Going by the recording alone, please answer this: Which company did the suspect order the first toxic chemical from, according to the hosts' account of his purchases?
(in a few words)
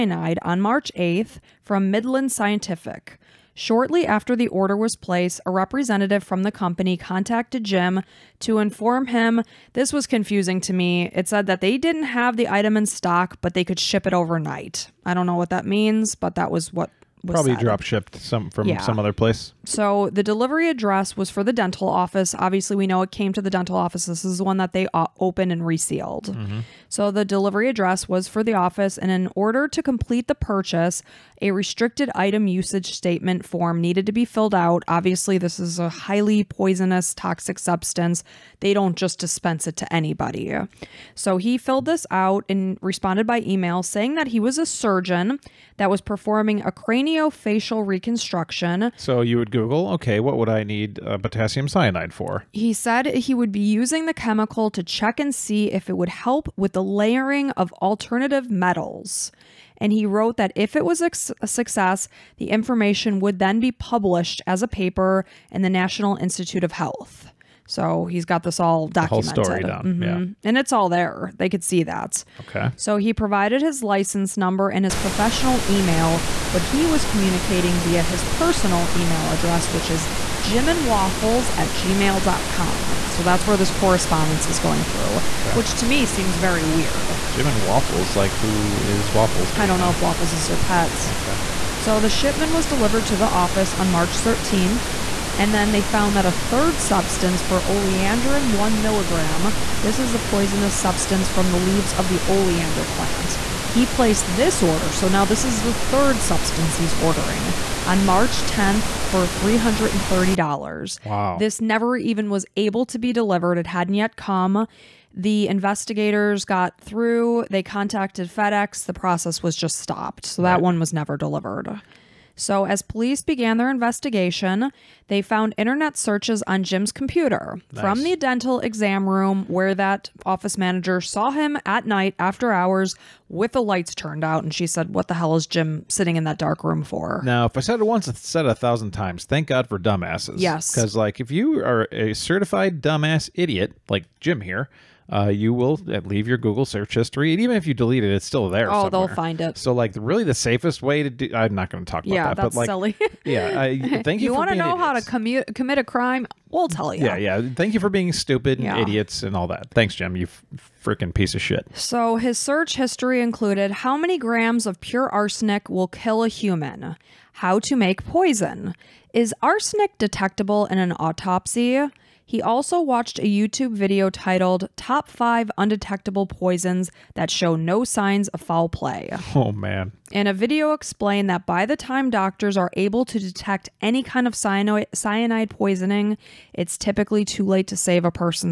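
Midland Scientific.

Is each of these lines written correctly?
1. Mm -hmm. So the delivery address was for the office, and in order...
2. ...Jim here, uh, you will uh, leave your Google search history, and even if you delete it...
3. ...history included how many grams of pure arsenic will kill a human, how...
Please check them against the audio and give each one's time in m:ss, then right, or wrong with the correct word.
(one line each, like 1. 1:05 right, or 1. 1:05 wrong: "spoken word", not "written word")
1. 0:26 right
2. 2:24 right
3. 2:42 right.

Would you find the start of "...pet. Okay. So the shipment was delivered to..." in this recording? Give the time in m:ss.
1:30.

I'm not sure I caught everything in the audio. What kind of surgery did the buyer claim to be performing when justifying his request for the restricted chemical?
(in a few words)
craniofacial reconstruction.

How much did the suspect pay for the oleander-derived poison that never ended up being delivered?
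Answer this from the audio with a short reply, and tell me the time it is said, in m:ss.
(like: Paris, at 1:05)
$330, at 1:49.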